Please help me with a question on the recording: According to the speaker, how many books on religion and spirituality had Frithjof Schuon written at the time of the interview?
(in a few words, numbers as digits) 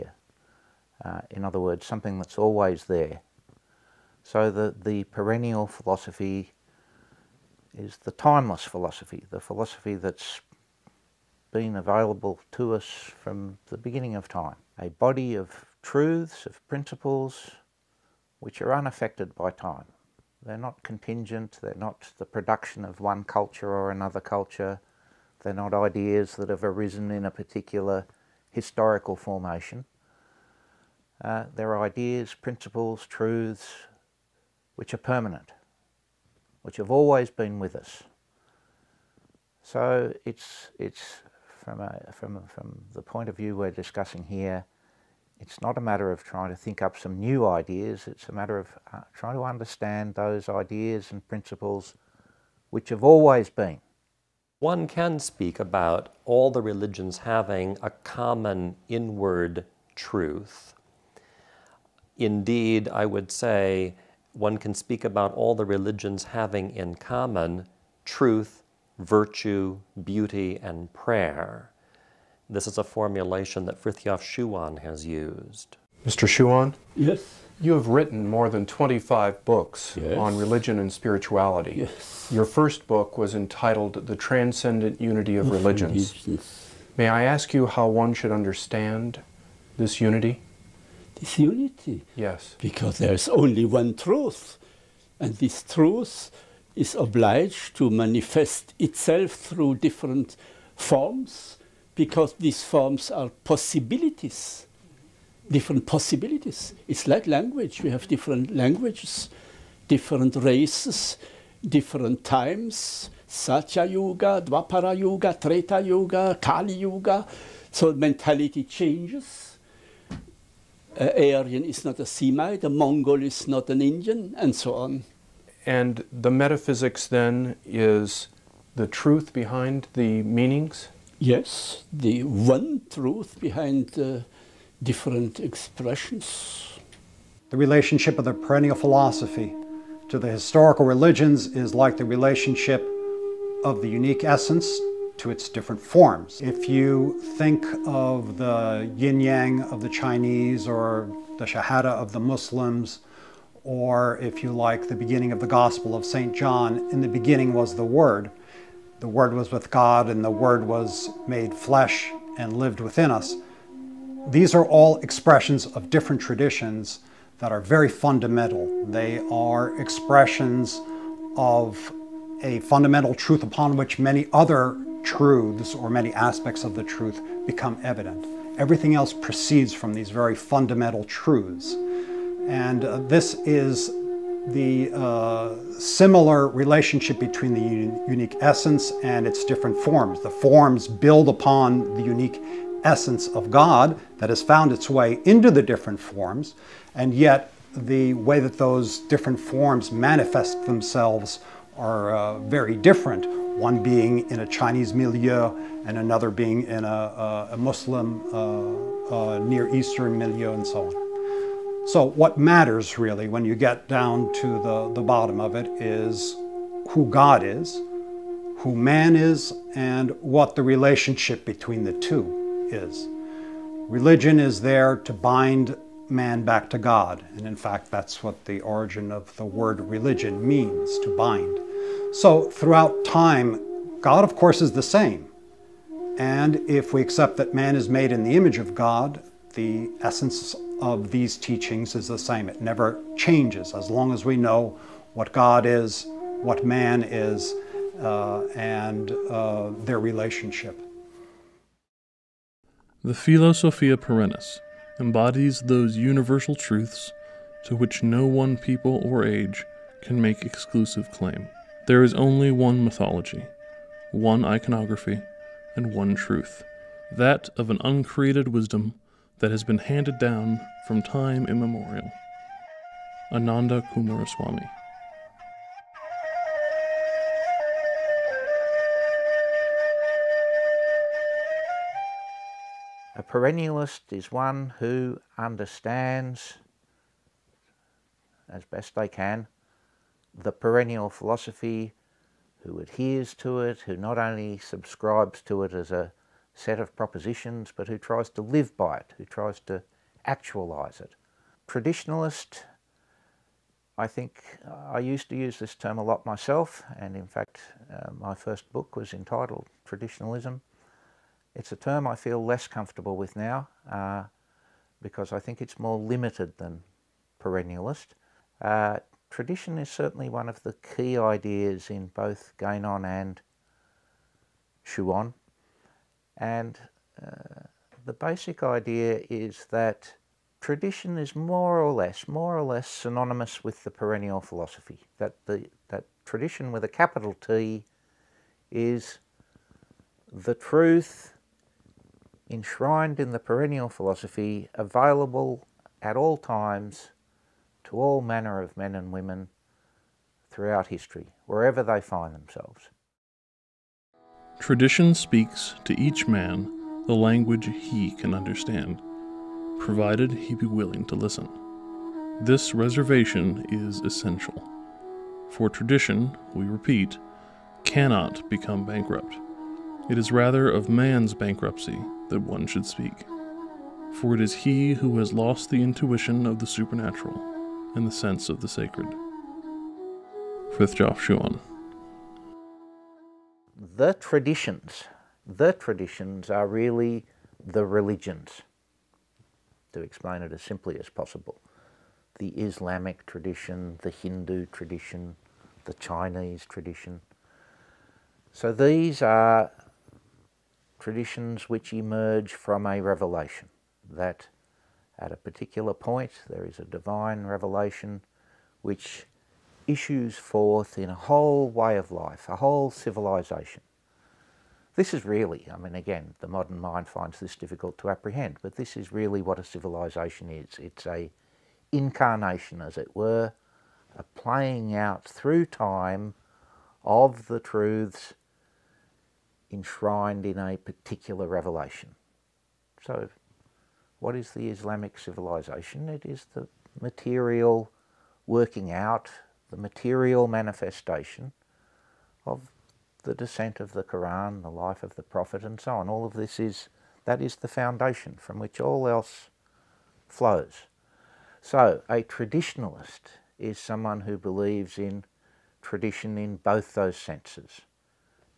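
More than 25.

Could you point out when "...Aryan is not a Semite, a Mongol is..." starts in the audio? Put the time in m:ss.
2:01.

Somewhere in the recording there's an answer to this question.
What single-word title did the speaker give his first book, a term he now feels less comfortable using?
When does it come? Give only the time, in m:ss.
5:09.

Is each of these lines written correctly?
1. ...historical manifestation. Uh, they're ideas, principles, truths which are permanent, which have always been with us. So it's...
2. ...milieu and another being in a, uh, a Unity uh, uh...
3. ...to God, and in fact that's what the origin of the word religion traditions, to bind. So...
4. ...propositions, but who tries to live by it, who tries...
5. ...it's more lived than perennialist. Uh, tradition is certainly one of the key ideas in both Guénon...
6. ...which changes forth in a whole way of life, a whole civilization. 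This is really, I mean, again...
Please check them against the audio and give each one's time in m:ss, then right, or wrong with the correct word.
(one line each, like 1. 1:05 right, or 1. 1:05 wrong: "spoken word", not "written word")
1. 0:28 wrong: "formation", not "manifestation"
2. 3:24 wrong: "Muslim", not "Unity"
3. 3:46 wrong: "means", not "traditions"
4. 4:56 right
5. 5:15 wrong: "limited", not "lived"
6. 6:48 wrong: "issues", not "changes".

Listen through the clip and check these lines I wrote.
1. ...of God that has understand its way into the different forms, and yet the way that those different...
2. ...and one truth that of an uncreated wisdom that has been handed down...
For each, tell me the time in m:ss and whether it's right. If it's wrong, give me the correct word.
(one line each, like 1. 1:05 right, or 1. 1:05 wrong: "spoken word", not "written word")
1. 3:13 wrong: "found", not "understand"
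2. 4:25 right.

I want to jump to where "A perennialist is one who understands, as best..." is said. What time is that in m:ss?
4:43.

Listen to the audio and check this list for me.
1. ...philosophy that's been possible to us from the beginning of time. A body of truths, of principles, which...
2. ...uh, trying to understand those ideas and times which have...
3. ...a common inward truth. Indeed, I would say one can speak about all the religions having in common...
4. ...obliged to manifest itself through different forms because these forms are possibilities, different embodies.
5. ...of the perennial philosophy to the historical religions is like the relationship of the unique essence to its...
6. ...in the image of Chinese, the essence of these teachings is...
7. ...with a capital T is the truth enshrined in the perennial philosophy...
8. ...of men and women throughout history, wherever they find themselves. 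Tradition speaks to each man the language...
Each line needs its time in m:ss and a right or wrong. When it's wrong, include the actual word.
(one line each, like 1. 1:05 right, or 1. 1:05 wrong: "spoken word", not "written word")
1. 0:09 wrong: "available", not "possible"
2. 0:48 wrong: "principles", not "times"
3. 0:57 right
4. 1:36 wrong: "possibilities", not "embodies"
5. 2:18 right
6. 3:58 wrong: "God", not "Chinese"
7. 5:36 right
8. 5:48 right.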